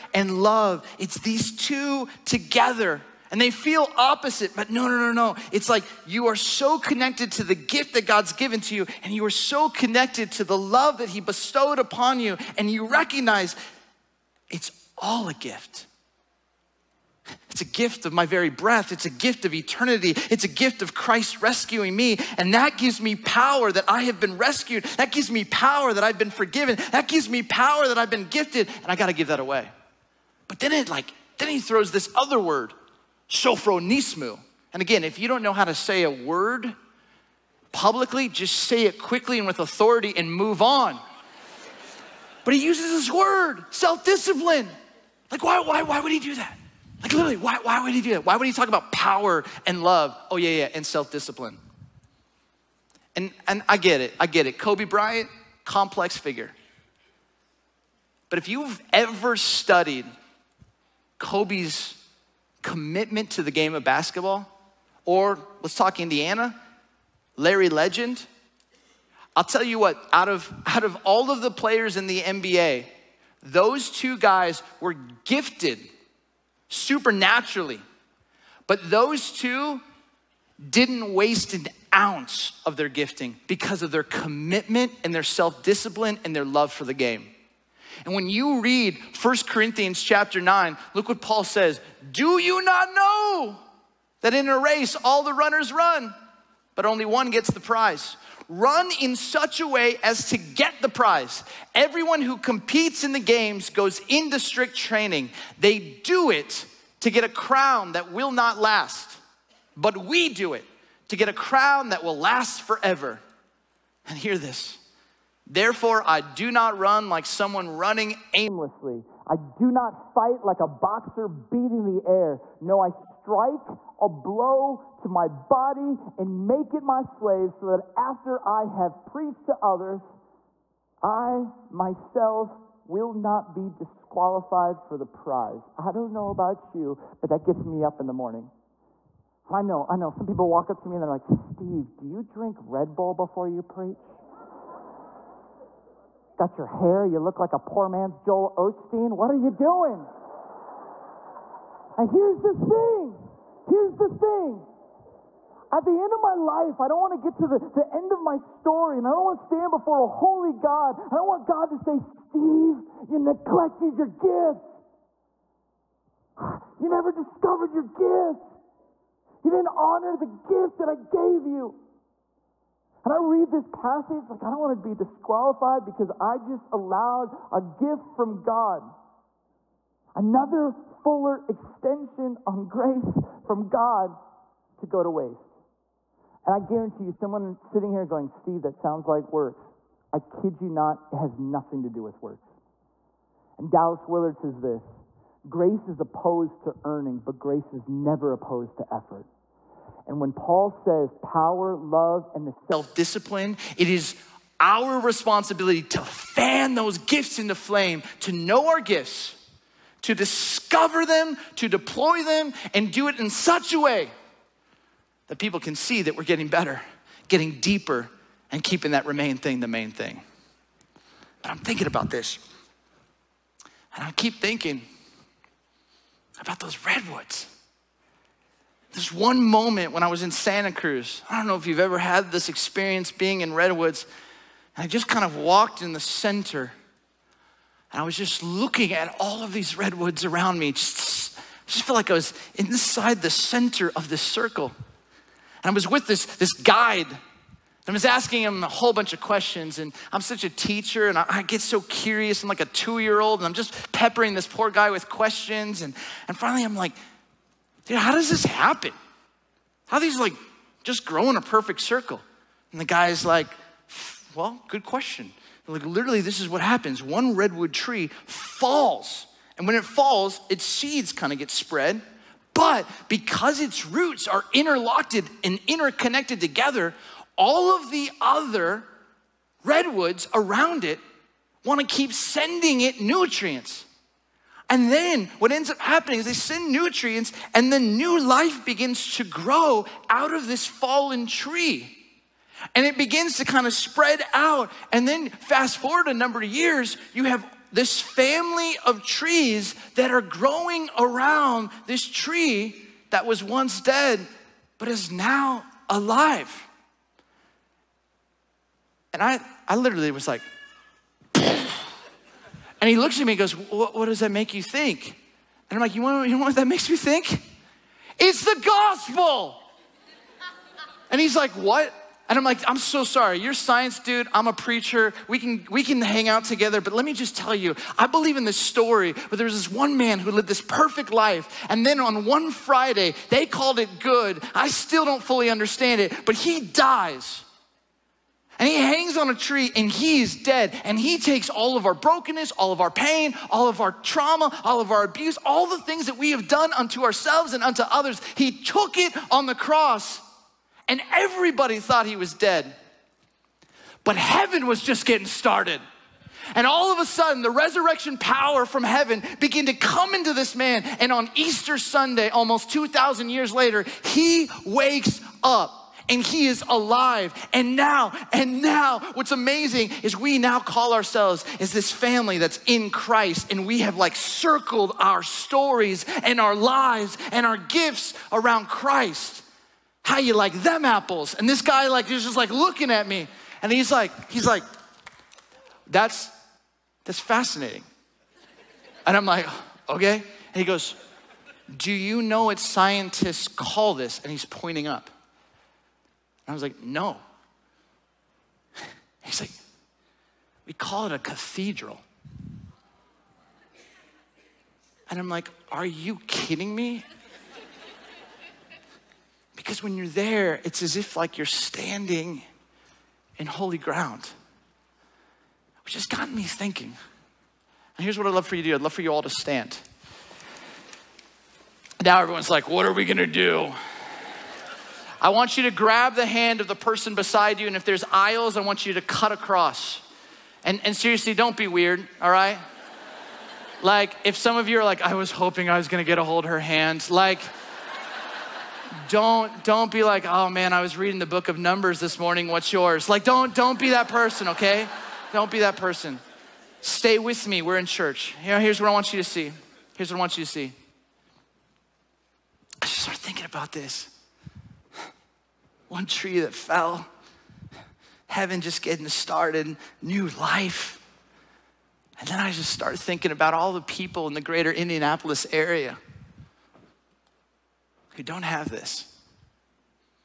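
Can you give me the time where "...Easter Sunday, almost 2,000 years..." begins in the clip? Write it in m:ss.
6:01.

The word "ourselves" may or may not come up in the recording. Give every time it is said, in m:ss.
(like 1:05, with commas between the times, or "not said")
5:47, 6:10.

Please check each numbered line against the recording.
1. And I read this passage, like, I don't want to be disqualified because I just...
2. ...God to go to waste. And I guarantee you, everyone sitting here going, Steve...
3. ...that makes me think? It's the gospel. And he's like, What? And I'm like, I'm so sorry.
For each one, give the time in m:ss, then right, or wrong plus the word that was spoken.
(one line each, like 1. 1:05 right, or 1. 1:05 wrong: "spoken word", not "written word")
1. 2:53 right
2. 3:03 wrong: "someone", not "everyone"
3. 5:16 right.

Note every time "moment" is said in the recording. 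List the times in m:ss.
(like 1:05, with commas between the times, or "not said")
3:49.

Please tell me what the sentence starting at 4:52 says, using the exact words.
And it begins to kind of spread out.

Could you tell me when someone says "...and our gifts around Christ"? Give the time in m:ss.
6:17.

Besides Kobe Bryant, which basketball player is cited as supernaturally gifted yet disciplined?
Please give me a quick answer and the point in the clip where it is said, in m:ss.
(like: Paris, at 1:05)
Larry Legend, at 1:07.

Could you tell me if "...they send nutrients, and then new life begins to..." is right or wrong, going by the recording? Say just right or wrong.
right.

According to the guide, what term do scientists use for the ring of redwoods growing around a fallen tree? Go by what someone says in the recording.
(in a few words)
cathedral.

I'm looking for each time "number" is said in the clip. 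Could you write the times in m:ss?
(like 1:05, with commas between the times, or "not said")
4:56, 7:21.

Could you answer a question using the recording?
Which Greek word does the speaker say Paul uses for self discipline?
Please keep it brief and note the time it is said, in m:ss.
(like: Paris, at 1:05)
sophronismu, at 0:33.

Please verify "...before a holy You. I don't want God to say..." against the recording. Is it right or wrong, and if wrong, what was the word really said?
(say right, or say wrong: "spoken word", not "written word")
wrong: "God", not "You".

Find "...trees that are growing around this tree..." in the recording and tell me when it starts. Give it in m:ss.
4:59.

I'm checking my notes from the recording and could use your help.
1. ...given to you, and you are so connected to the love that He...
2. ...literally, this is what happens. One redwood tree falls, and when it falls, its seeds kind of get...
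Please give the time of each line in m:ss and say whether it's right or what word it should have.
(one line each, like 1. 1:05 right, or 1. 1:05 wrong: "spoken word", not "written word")
1. 0:08 right
2. 4:25 right.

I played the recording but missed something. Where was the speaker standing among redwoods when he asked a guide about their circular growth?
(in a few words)
Santa Cruz.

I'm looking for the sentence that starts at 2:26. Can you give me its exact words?
got your hair, you look like a poor man's Joel Osteen.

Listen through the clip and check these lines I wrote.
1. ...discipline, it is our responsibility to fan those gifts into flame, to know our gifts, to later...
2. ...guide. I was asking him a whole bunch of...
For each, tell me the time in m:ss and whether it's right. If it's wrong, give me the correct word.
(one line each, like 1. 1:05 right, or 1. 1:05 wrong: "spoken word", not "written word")
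1. 3:22 wrong: "discover", not "later"
2. 4:06 right.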